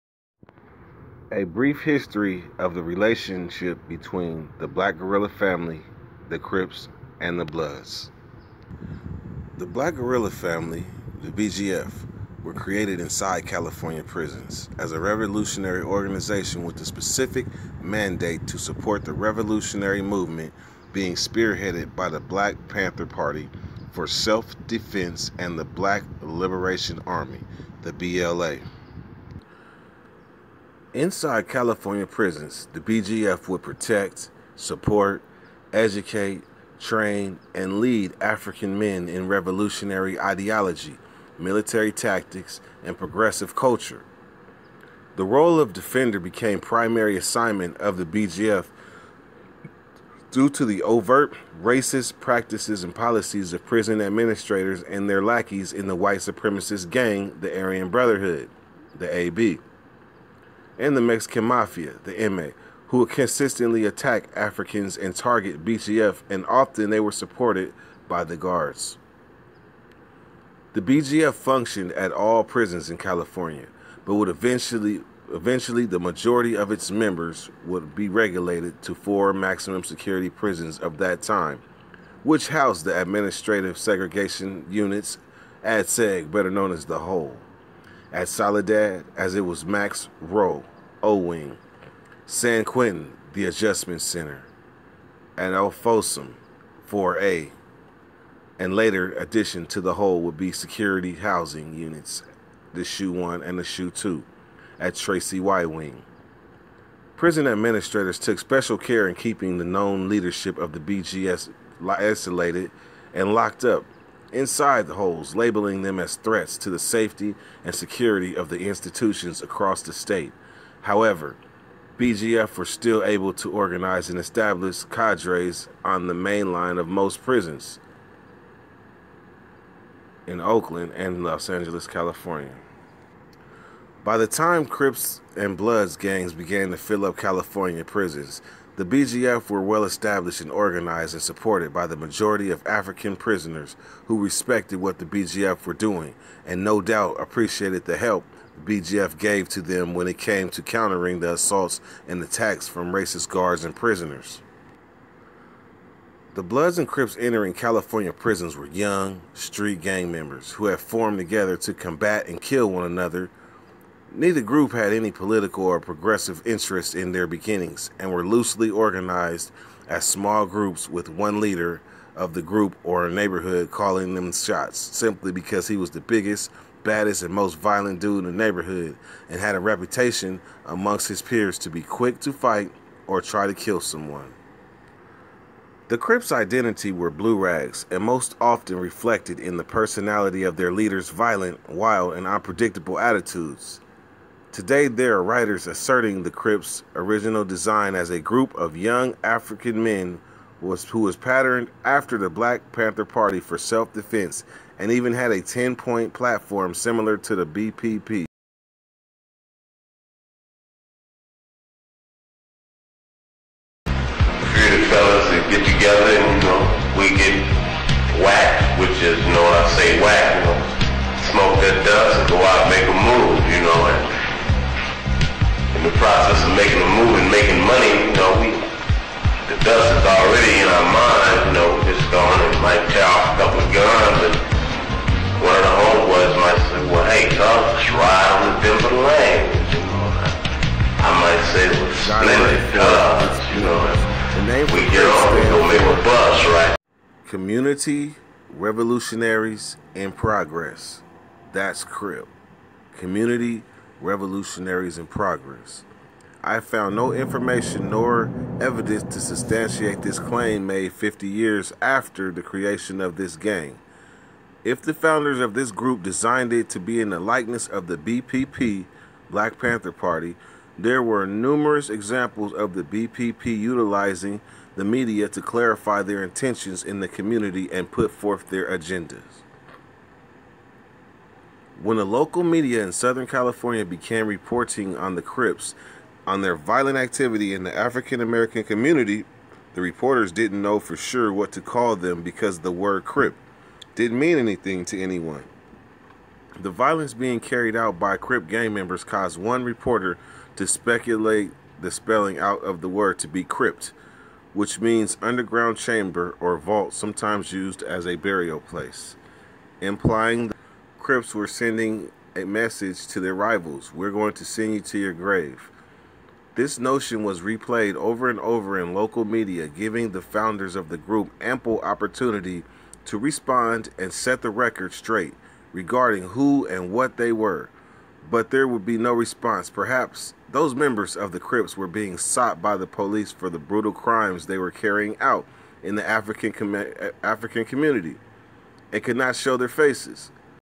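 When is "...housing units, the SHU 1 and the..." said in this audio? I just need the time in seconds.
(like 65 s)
101 s.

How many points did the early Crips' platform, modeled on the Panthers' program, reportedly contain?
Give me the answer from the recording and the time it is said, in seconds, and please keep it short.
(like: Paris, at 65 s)
10, at 205 s.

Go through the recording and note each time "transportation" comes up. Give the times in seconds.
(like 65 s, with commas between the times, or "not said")
not said.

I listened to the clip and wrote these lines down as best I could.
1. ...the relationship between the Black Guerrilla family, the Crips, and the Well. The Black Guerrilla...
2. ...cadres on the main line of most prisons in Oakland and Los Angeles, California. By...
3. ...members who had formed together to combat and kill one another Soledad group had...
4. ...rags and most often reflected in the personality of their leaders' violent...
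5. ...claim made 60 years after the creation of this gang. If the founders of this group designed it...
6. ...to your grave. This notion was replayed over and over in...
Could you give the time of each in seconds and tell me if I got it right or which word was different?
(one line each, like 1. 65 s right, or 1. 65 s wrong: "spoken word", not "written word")
1. 2 s wrong: "Bloods", not "Well"
2. 124 s right
3. 160 s wrong: "Neither", not "Soledad"
4. 187 s right
5. 260 s wrong: "50", not "60"
6. 314 s right.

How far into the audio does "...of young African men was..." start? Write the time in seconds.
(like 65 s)
198 s.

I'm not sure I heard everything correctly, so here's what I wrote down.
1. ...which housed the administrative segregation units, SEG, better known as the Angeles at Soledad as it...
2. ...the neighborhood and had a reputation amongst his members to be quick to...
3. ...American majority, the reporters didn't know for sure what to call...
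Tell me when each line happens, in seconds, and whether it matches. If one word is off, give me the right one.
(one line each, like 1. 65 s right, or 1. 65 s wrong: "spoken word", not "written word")
1. 82 s wrong: "Hole", not "Angeles"
2. 178 s wrong: "peers", not "members"
3. 288 s wrong: "community", not "majority".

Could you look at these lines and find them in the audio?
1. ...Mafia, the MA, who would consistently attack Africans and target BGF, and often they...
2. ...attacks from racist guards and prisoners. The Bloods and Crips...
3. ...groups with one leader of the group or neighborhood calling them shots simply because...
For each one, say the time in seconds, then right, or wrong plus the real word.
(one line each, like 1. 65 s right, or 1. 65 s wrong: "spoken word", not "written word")
1. 61 s right
2. 152 s right
3. 170 s right.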